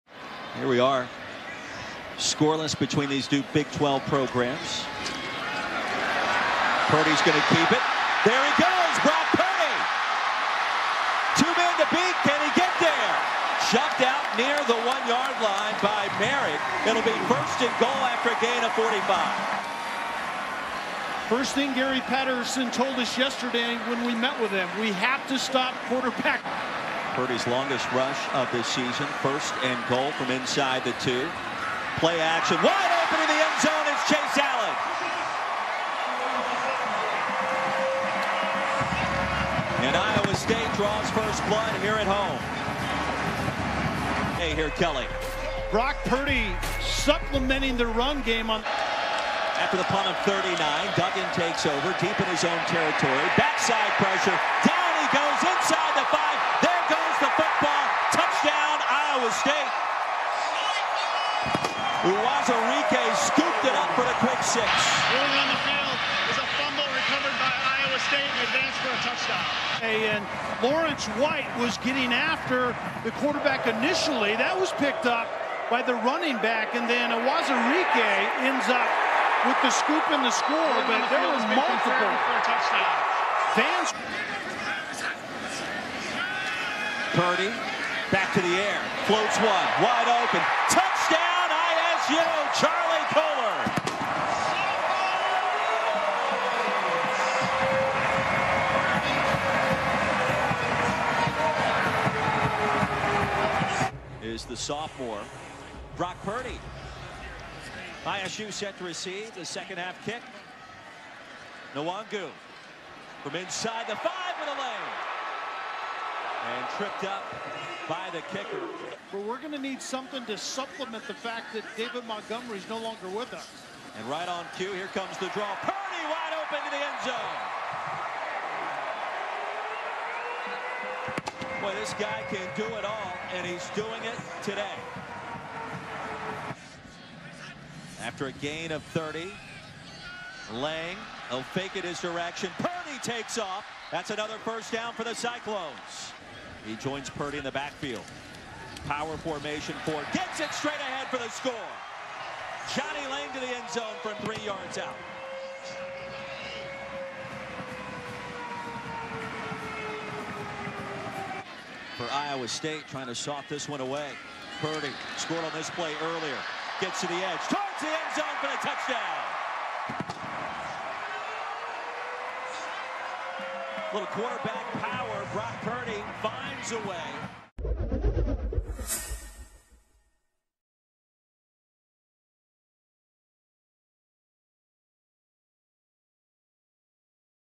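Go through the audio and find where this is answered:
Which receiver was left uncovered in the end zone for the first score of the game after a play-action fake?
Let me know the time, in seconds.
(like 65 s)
34 s.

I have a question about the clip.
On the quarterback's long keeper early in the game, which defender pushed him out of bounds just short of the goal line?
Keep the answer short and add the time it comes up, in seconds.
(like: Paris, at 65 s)
Merrick, at 16 s.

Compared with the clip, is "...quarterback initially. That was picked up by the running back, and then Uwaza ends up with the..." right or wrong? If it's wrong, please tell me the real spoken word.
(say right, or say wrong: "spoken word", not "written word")
right.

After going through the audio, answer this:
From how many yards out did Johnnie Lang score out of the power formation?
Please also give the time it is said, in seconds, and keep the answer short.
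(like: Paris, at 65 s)
3 yards, at 154 s.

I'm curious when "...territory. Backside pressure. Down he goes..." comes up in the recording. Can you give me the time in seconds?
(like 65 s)
52 s.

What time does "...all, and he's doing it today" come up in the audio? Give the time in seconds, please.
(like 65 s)
132 s.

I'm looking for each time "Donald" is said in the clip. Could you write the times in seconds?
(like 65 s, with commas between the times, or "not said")
not said.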